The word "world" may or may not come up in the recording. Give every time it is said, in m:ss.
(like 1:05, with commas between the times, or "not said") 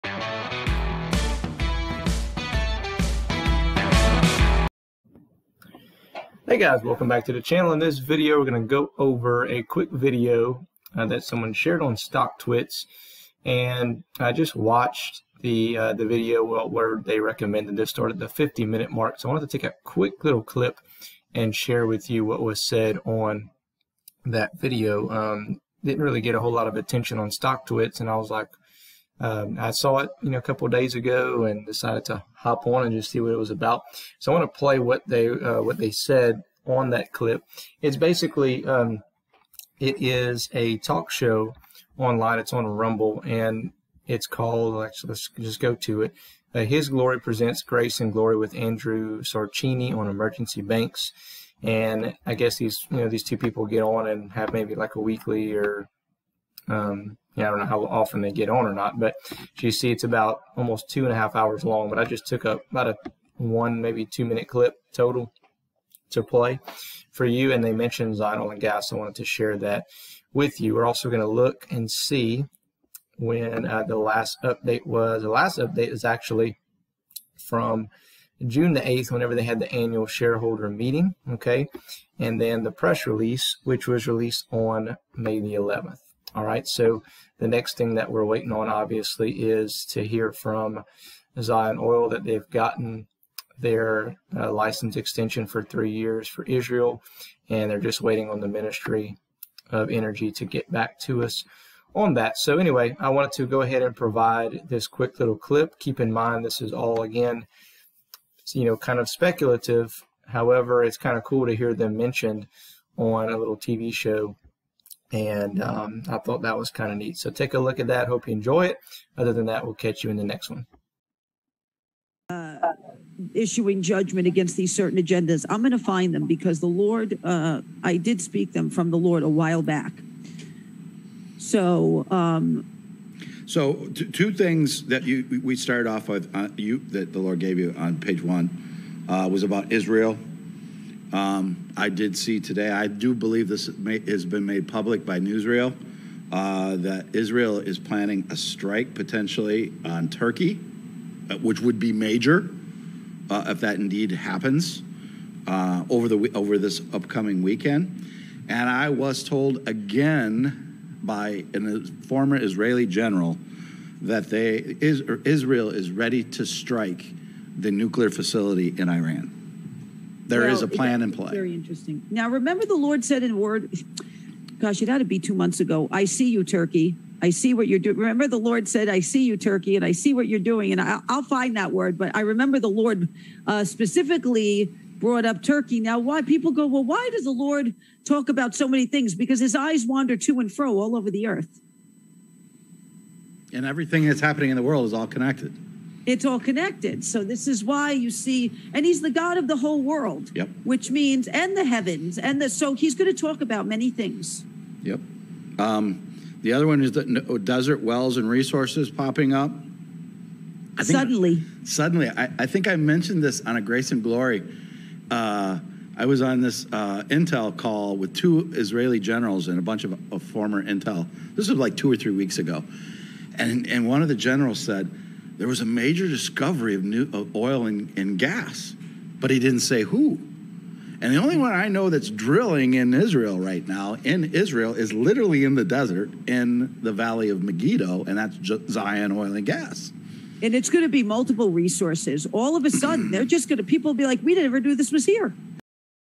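3:14, 3:19.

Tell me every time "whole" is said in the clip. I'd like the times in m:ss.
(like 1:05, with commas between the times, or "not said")
0:26, 3:19.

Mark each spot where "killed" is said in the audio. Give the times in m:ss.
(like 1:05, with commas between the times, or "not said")
not said.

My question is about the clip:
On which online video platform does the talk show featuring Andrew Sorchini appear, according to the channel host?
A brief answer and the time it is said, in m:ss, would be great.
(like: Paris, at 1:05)
Rumble, at 0:42.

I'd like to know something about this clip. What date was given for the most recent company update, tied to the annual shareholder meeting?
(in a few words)
June 8.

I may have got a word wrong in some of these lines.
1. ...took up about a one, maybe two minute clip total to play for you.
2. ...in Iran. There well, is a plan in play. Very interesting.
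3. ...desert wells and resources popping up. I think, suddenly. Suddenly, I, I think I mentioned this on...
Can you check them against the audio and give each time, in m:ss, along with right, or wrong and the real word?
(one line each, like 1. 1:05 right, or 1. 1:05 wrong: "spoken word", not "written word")
1. 1:02 right
2. 2:48 right
3. 3:27 right.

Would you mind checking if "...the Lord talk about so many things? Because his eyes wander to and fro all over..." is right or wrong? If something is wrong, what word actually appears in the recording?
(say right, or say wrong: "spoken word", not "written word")
right.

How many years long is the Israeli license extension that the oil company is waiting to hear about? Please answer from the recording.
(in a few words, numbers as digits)
3 years.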